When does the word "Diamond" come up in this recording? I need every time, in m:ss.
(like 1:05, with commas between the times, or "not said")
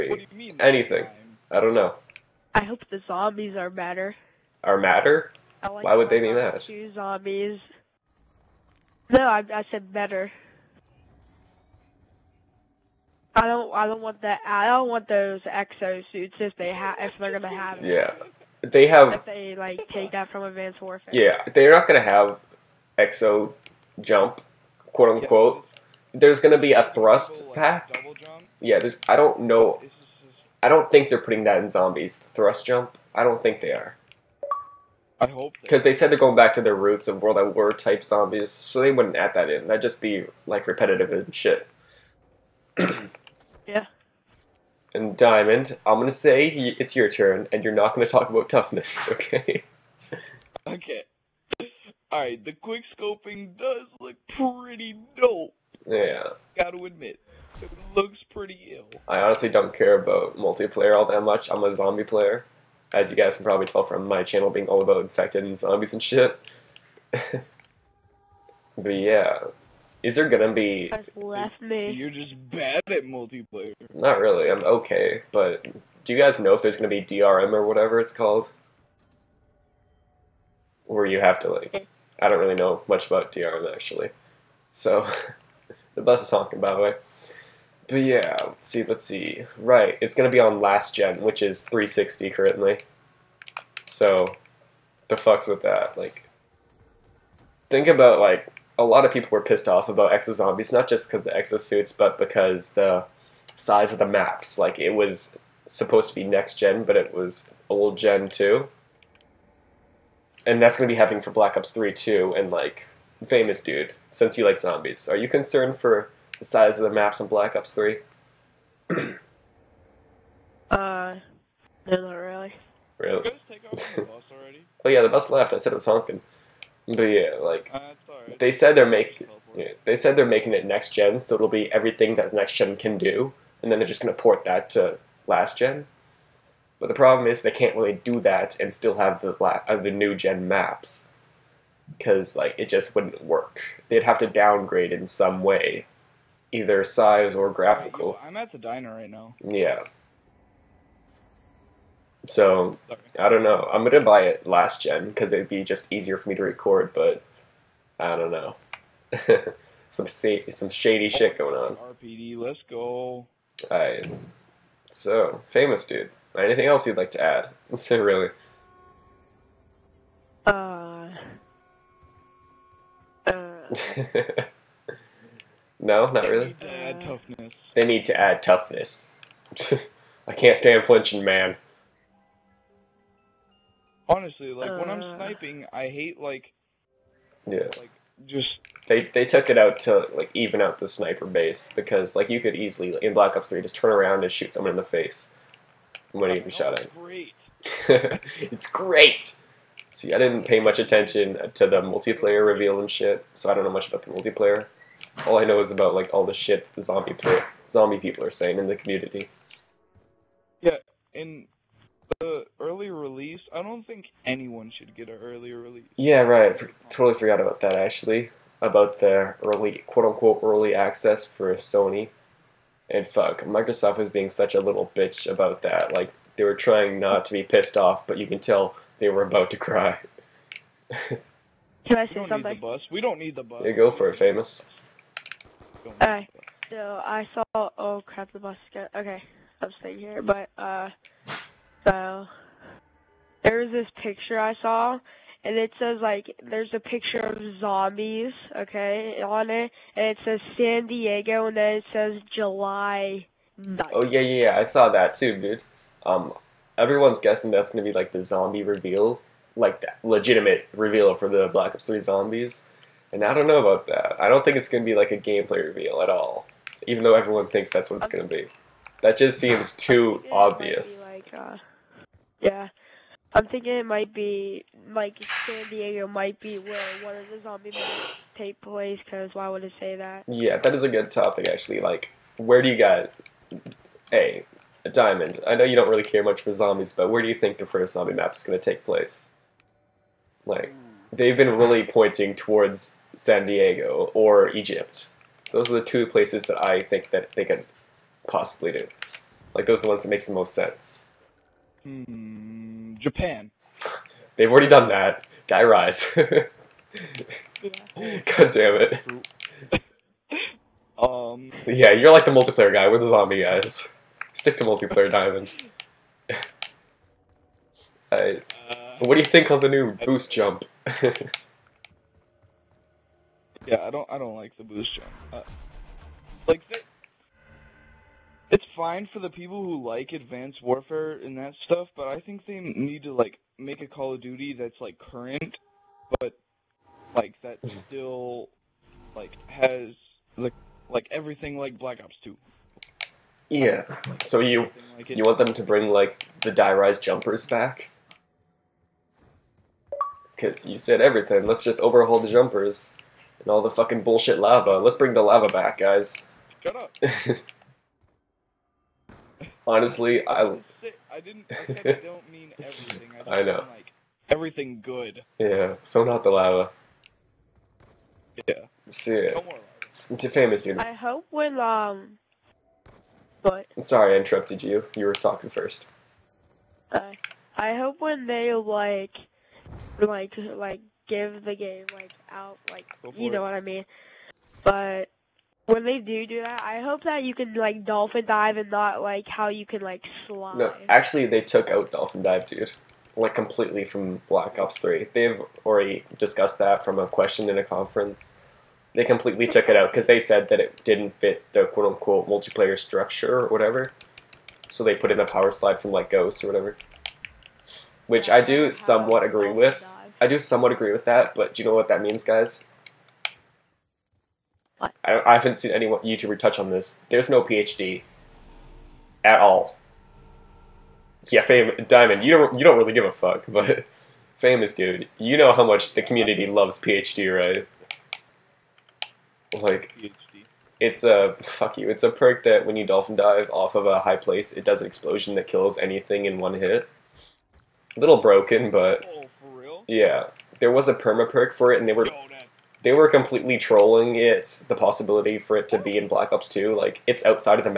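0:45, 4:44, 5:15, 7:01.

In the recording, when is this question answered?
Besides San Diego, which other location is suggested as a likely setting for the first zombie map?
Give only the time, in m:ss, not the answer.
4:54.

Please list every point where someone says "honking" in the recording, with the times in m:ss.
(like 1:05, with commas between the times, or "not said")
1:26, 2:05.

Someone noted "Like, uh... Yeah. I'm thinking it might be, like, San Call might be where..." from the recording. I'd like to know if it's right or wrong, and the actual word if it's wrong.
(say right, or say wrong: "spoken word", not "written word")
wrong: "Diego", not "Call".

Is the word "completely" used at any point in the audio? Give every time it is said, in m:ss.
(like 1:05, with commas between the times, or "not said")
6:33, 6:39, 7:23.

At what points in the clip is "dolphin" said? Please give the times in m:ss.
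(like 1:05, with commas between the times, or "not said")
6:27, 6:31, 7:12.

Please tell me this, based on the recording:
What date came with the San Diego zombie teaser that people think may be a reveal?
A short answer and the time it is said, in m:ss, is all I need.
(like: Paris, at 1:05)
July 9th, at 4:12.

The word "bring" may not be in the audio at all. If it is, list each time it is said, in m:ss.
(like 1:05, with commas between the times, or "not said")
5:45, 5:54.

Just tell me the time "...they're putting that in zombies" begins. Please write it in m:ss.
0:31.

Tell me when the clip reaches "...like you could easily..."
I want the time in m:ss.
3:12.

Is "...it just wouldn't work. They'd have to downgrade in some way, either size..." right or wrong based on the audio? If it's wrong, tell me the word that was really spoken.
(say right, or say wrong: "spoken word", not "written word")
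right.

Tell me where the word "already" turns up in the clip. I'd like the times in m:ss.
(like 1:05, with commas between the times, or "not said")
5:04, 6:35.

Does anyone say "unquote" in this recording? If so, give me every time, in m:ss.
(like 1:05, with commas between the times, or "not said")
0:25, 3:40, 6:41.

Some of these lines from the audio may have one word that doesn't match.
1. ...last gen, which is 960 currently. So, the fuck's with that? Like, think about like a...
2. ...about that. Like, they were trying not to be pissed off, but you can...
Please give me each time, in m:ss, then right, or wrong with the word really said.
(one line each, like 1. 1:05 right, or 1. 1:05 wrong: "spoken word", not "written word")
1. 1:30 wrong: "360", not "960"
2. 3:45 right.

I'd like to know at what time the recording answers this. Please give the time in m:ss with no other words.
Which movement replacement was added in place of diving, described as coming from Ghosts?
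6:45.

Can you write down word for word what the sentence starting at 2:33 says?
I'm gonna buy it last gen because it'd be just easier for me to record, but I don't know.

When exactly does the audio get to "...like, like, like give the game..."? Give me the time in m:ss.
6:18.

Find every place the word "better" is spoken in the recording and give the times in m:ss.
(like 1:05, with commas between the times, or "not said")
0:03, 0:09.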